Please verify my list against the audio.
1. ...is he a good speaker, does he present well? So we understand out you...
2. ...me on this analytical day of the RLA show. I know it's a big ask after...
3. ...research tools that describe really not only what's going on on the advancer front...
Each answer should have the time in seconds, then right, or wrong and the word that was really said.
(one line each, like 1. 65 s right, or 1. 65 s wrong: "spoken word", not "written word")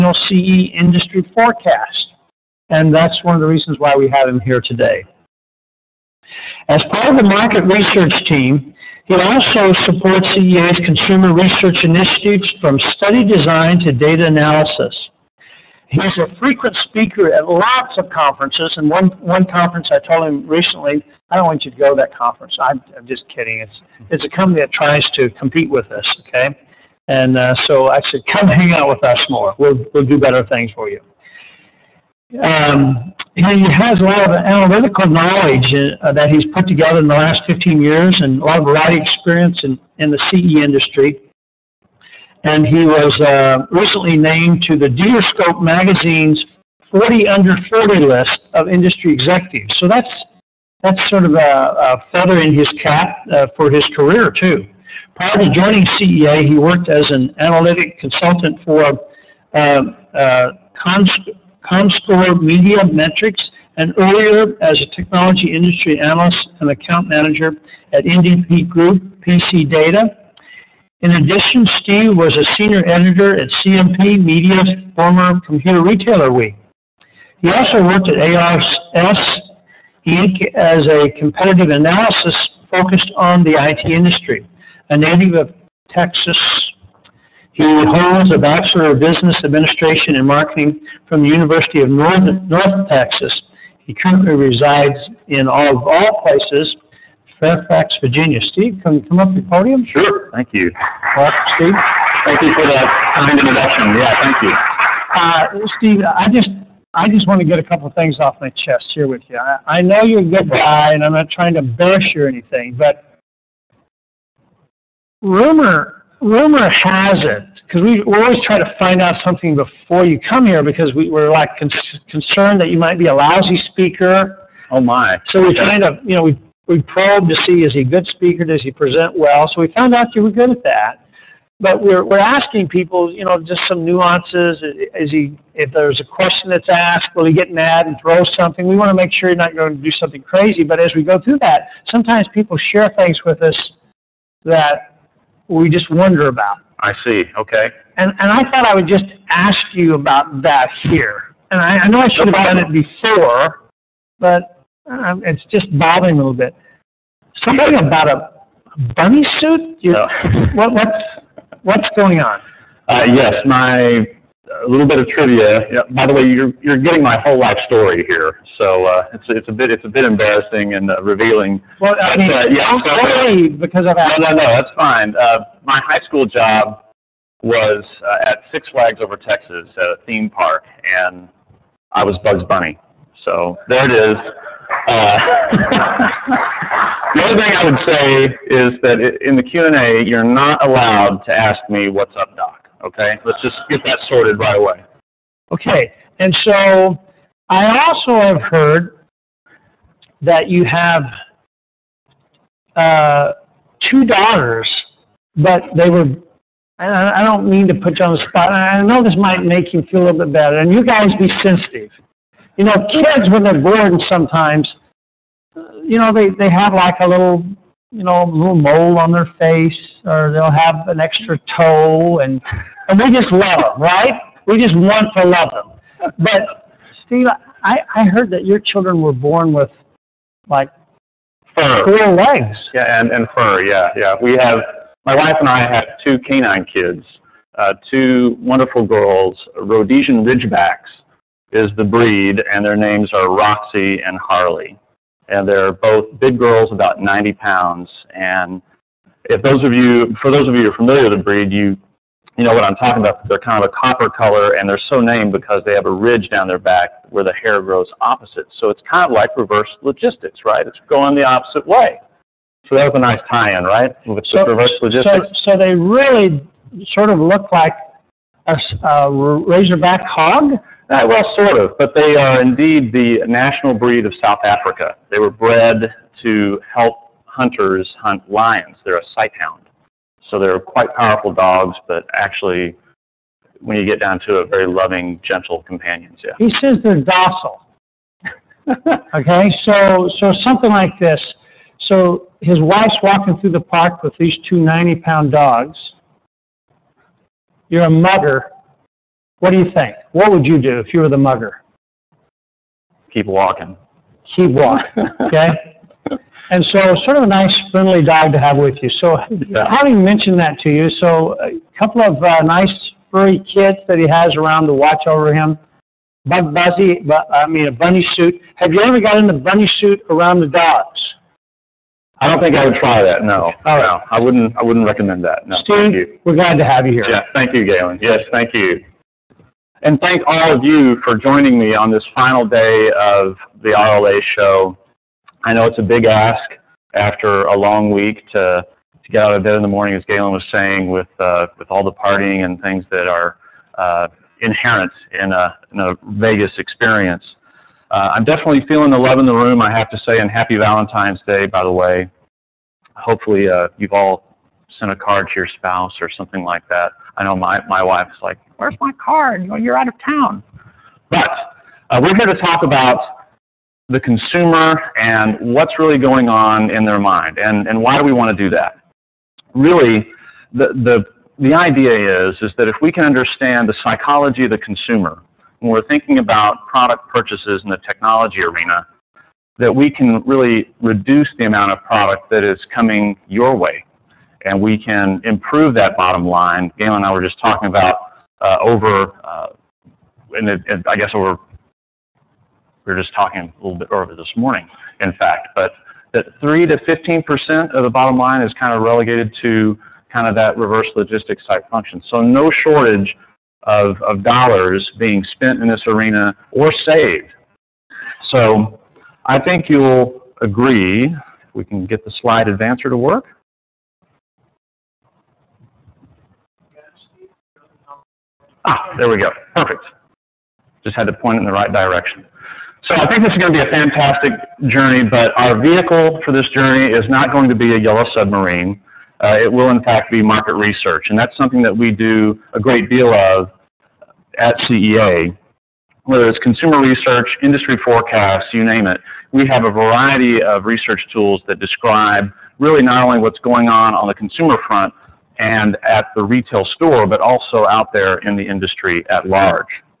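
1. 127 s wrong: "found", not "understand"
2. 331 s wrong: "final", not "analytical"
3. 440 s wrong: "consumer", not "advancer".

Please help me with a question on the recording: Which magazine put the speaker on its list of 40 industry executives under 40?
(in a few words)
Dealerscope.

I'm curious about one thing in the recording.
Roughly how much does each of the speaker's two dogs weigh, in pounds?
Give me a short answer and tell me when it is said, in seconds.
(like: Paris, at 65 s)
90 pounds, at 246 s.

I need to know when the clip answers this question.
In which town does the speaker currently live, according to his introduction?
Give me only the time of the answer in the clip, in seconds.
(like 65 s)
97 s.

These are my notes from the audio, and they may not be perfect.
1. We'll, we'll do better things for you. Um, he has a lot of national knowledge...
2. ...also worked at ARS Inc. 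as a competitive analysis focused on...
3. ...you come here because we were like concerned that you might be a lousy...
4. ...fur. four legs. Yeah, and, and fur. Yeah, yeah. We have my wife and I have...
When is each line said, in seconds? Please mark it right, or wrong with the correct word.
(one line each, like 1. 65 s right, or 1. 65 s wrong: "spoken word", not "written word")
1. 29 s wrong: "analytical", not "national"
2. 77 s right
3. 120 s right
4. 231 s right.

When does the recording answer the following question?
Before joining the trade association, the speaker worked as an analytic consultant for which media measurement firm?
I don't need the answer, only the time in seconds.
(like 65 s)
61 s.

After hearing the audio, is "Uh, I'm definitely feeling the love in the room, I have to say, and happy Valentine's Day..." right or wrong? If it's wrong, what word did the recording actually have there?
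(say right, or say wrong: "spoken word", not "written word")
right.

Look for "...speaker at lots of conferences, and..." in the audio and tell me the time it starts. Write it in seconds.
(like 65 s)
16 s.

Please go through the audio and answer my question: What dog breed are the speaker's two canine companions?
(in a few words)
Rhodesian Ridgebacks.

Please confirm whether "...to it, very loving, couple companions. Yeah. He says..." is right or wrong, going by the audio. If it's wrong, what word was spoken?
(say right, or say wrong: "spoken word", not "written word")
wrong: "gentle", not "couple".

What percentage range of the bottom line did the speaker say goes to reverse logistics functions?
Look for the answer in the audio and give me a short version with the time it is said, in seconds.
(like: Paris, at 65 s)
3 to 15%, at 396 s.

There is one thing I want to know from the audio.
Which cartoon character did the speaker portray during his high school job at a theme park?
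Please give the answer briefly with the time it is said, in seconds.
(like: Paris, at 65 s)
Bugs Bunny, at 182 s.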